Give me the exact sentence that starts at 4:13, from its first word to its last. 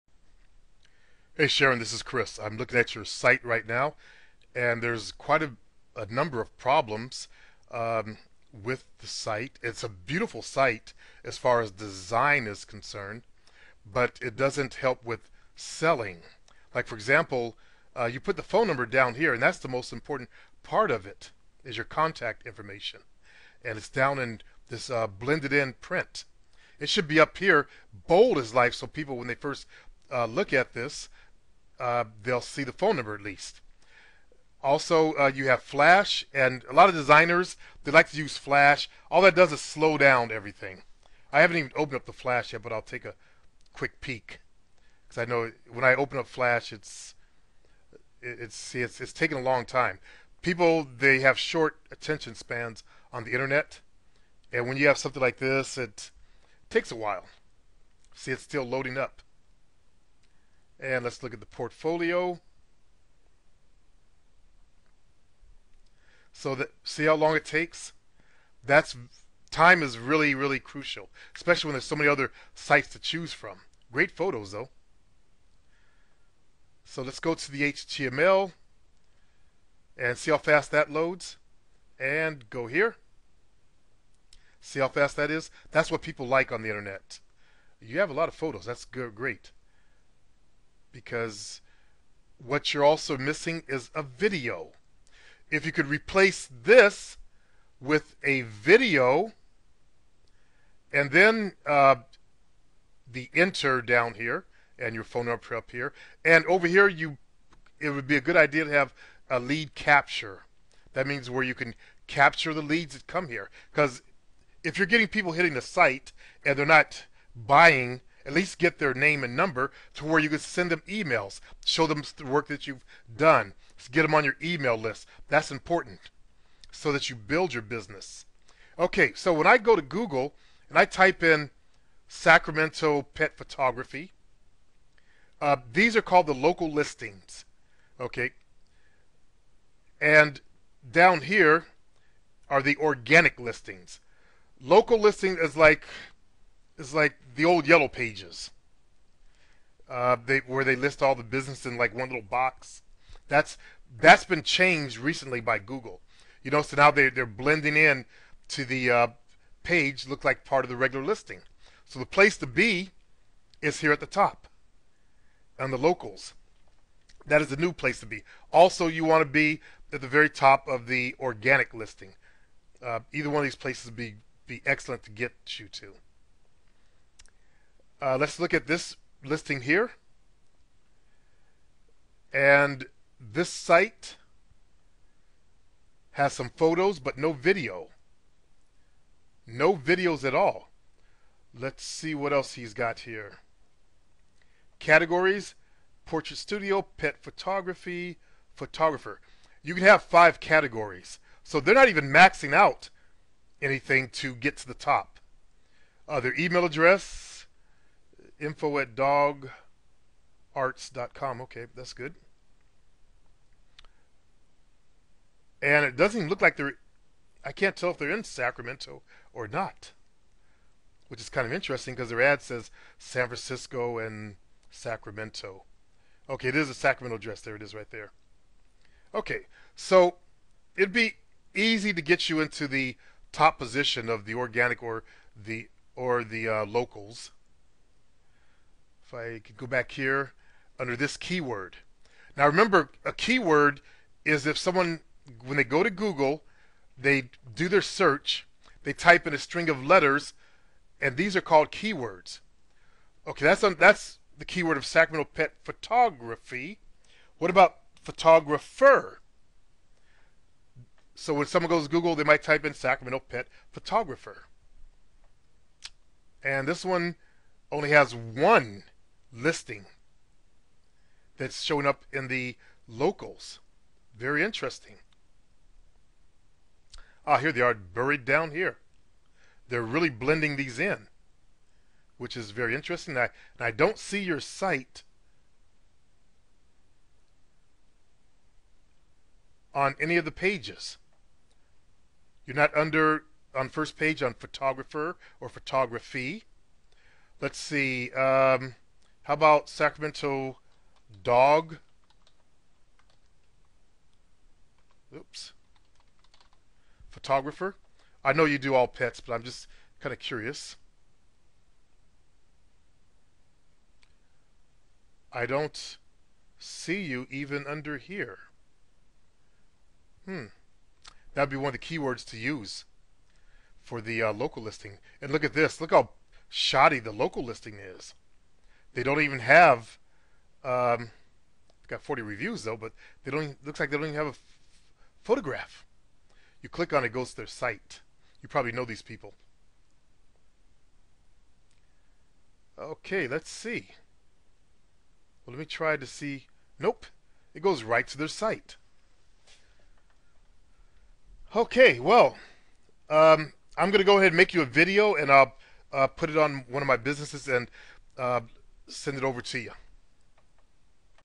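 Okay, that's on, that's the keyword of Sacramento pet photography.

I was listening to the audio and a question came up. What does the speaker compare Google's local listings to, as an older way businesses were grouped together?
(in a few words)
the old yellow pages.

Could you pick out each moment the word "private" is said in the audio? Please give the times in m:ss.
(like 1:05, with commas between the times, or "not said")
not said.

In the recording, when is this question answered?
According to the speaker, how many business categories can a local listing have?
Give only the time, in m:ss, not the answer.
3:20.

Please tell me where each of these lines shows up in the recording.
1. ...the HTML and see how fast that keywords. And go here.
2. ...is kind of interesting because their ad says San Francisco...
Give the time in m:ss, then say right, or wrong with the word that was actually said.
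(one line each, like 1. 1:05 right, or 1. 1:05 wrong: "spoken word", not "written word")
1. 1:17 wrong: "loads", not "keywords"
2. 3:41 right.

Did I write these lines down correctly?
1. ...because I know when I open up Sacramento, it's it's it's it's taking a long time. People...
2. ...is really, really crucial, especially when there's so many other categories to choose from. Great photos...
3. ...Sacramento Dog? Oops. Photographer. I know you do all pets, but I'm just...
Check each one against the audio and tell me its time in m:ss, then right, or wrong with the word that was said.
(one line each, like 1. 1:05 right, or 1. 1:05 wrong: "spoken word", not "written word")
1. 0:45 wrong: "Flash", not "Sacramento"
2. 1:09 wrong: "sites", not "categories"
3. 4:59 right.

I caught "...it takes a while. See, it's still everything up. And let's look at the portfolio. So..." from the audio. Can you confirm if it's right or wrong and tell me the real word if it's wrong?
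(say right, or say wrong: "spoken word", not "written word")
wrong: "loading", not "everything".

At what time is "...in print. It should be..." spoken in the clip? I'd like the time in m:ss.
0:25.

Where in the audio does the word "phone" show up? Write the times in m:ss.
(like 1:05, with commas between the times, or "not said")
0:18, 0:32, 1:45.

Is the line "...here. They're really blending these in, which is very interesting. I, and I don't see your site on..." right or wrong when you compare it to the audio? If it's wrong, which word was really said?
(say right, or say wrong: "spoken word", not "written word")
right.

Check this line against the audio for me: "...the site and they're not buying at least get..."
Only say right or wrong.
right.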